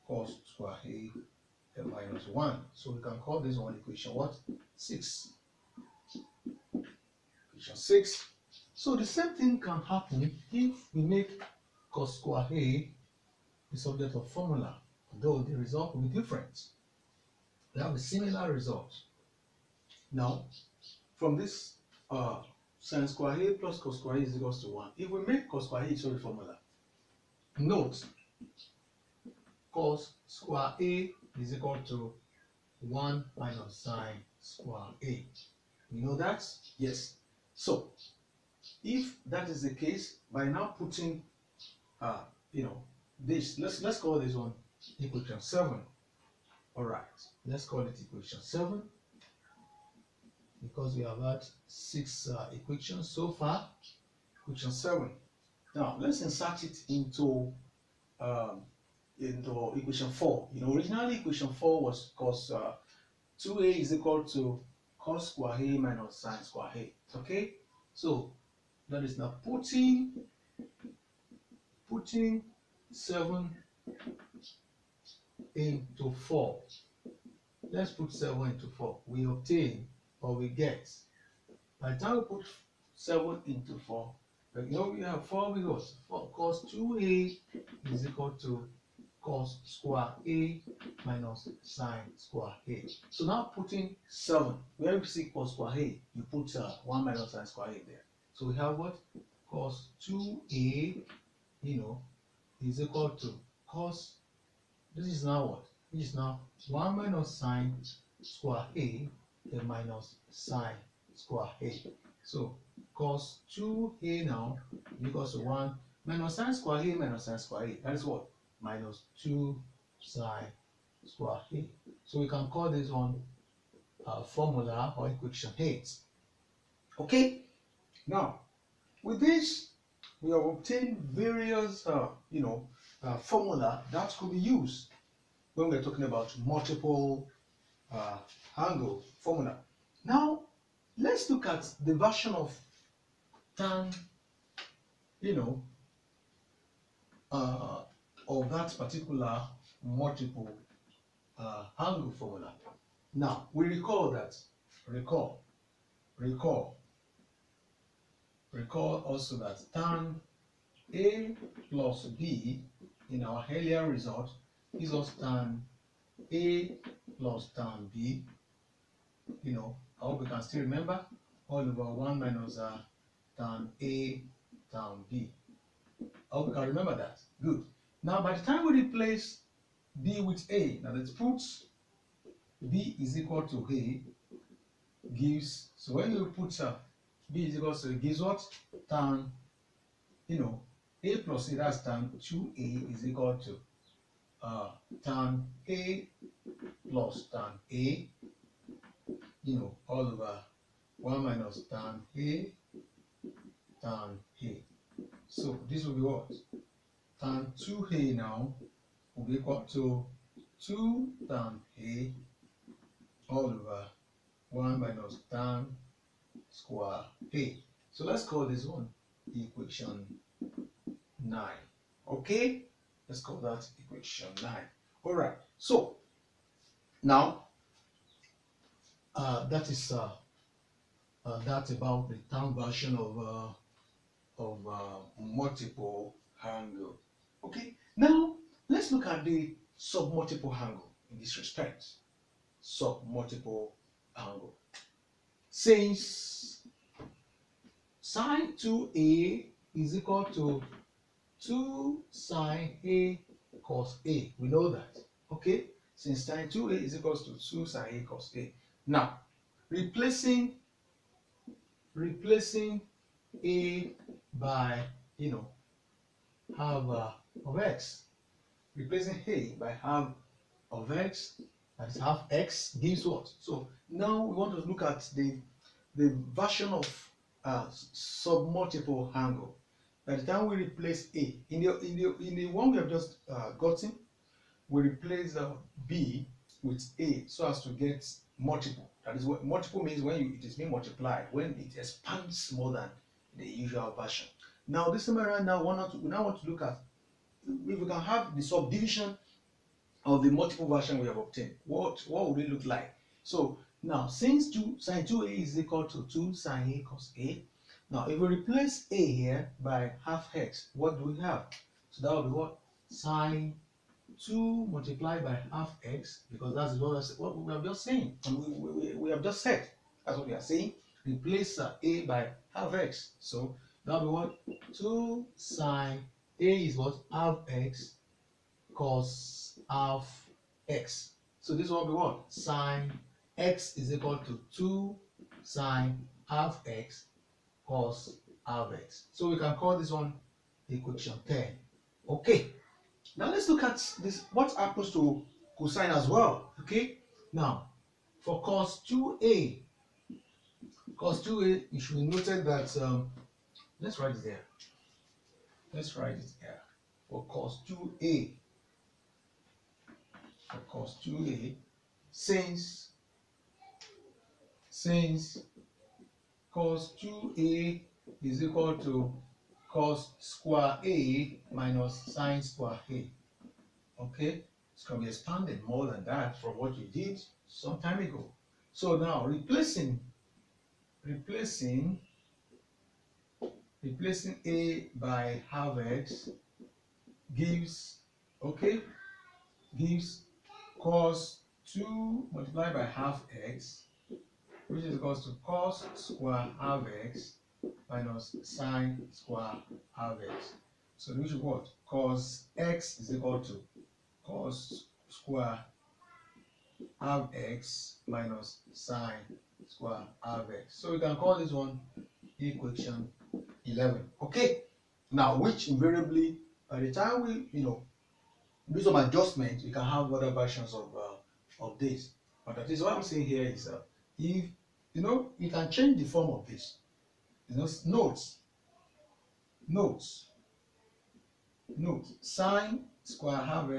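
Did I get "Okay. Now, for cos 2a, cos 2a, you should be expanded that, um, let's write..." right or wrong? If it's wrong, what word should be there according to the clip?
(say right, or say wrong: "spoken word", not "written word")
wrong: "noted", not "expanded".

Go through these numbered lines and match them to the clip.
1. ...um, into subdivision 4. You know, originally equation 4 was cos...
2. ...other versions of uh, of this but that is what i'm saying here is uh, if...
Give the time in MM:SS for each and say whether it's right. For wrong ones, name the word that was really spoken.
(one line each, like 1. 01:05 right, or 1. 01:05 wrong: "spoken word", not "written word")
1. 00:58 wrong: "equation", not "subdivision"
2. 07:00 right.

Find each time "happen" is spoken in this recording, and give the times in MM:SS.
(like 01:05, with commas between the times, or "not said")
00:09, 05:44.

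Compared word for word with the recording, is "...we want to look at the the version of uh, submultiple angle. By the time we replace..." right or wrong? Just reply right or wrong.
right.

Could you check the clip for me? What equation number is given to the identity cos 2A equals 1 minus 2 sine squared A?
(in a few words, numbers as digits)
8.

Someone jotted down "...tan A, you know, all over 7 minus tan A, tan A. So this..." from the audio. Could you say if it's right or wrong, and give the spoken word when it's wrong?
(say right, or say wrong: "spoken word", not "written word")
wrong: "1", not "7".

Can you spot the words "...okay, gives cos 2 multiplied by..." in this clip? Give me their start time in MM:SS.
06:28.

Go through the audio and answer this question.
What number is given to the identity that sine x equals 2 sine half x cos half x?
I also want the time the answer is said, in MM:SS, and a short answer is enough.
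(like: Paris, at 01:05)
10, at 05:40.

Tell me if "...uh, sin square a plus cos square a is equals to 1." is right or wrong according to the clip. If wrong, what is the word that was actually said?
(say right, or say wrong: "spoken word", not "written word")
right.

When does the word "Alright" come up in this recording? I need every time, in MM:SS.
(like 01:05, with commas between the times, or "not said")
00:46, 03:45.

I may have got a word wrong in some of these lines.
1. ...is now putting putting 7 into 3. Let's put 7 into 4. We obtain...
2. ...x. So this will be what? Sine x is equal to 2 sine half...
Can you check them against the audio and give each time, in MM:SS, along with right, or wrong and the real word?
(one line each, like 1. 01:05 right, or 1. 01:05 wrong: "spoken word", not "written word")
1. 01:09 wrong: "4", not "3"
2. 05:30 right.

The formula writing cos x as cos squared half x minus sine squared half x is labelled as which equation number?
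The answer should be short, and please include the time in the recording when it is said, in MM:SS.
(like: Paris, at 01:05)
11, at 06:52.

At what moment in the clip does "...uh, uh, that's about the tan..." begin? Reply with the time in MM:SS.
03:49.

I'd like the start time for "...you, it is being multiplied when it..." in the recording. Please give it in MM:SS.
04:50.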